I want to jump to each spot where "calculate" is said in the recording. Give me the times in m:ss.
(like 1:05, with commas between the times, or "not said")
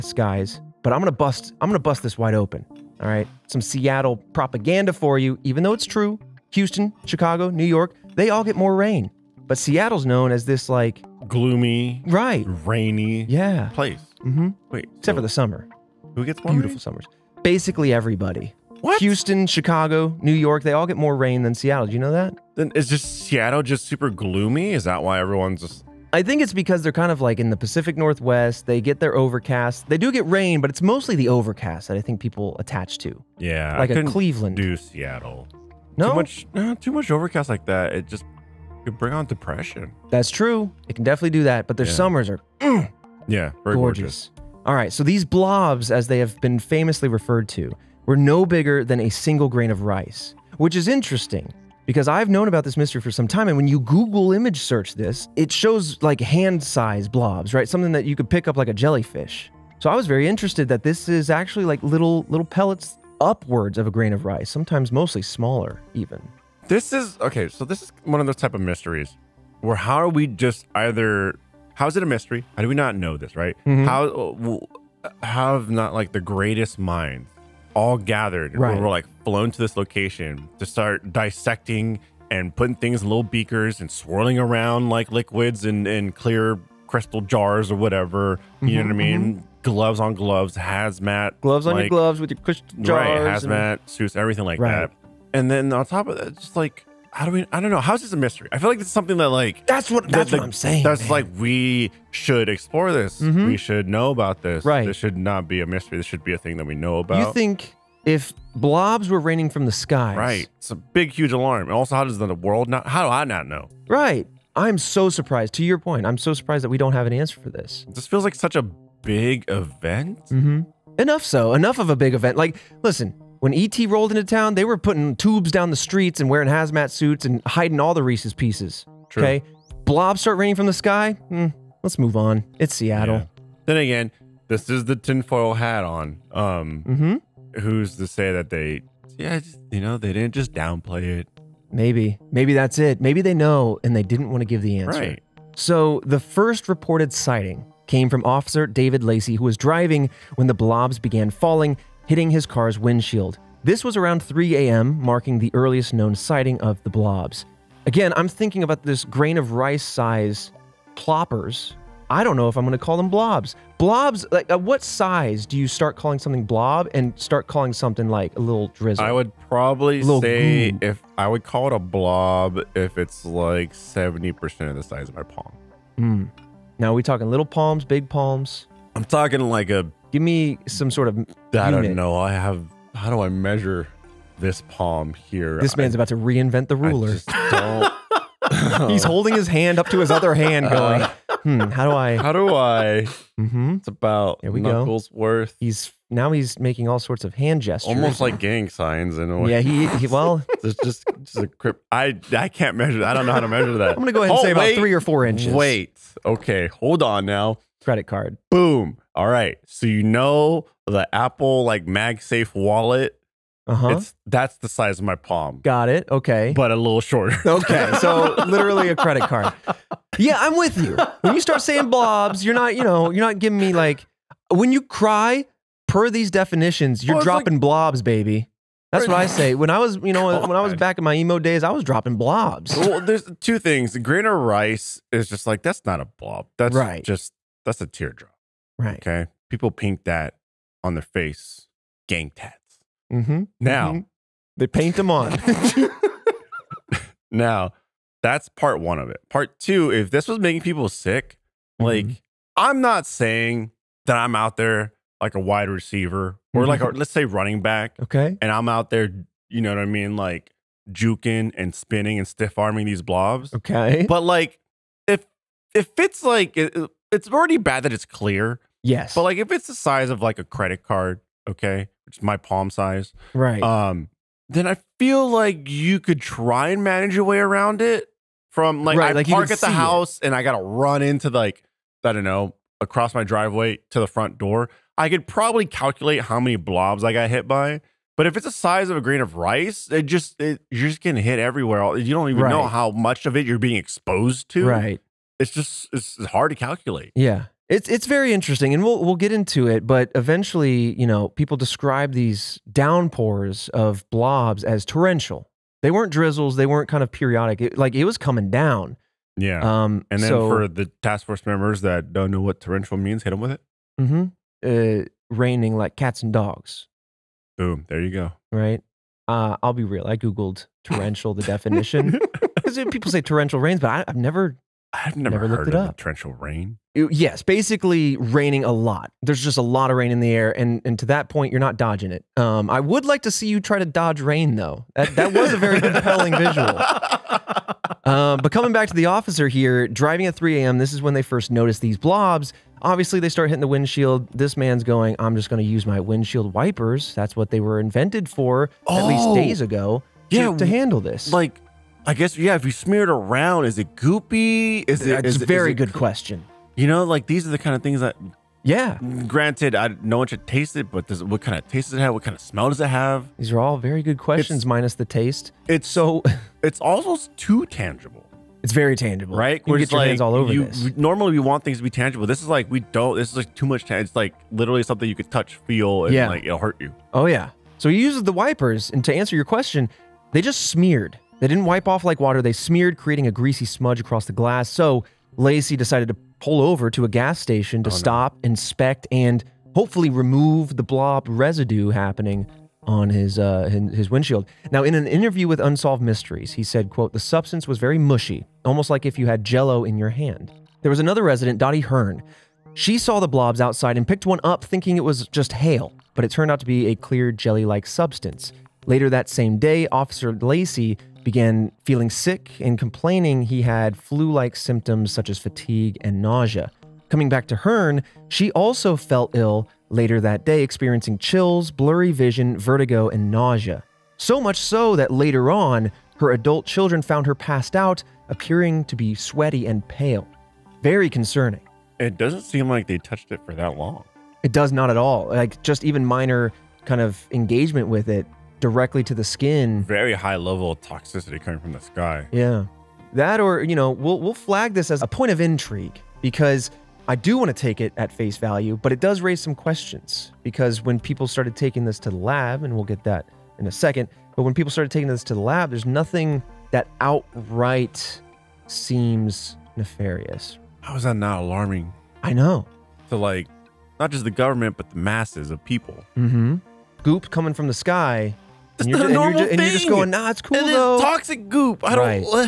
4:45, 4:56.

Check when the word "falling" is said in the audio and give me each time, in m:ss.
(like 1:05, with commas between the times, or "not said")
2:31.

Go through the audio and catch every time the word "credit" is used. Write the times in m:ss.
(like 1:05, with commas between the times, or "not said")
3:27, 3:38, 4:30.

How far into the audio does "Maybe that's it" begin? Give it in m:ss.
2:22.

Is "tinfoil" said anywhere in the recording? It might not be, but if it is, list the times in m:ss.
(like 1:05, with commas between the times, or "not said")
2:14.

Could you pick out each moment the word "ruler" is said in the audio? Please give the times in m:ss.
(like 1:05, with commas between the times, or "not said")
3:06.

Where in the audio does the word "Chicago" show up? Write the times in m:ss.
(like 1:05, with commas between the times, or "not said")
0:07, 0:19.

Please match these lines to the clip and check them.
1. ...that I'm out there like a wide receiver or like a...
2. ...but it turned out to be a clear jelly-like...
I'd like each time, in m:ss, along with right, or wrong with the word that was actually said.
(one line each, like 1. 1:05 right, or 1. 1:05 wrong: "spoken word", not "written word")
1. 4:14 right
2. 6:46 right.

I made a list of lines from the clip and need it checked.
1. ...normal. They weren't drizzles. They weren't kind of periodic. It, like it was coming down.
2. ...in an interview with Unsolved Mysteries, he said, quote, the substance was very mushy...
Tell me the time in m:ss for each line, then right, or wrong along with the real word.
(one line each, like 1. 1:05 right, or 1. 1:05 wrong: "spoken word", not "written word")
1. 5:04 wrong: "torrential", not "normal"
2. 6:34 right.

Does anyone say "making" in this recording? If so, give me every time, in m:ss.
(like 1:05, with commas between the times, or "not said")
3:16, 4:10.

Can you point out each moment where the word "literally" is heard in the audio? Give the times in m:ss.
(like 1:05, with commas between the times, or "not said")
3:38, 6:14.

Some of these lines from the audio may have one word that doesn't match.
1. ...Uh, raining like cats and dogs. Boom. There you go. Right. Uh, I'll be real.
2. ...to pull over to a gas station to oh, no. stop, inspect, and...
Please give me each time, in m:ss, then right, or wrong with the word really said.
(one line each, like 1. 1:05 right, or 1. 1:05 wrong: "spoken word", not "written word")
1. 5:14 right
2. 6:26 right.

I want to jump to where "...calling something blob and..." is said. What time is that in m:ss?
2:45.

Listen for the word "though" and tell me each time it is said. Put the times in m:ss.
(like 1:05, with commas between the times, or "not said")
0:05, 5:34, 7:50.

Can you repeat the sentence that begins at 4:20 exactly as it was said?
Like juking and spinning and stiff arming these blobs.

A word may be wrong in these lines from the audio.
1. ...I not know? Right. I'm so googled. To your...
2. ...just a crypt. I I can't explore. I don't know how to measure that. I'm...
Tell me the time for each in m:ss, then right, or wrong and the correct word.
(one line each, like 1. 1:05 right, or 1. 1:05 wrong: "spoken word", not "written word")
1. 1:53 wrong: "surprised", not "googled"
2. 3:21 wrong: "measure", not "explore".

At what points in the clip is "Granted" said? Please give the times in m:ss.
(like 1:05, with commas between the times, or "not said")
5:59.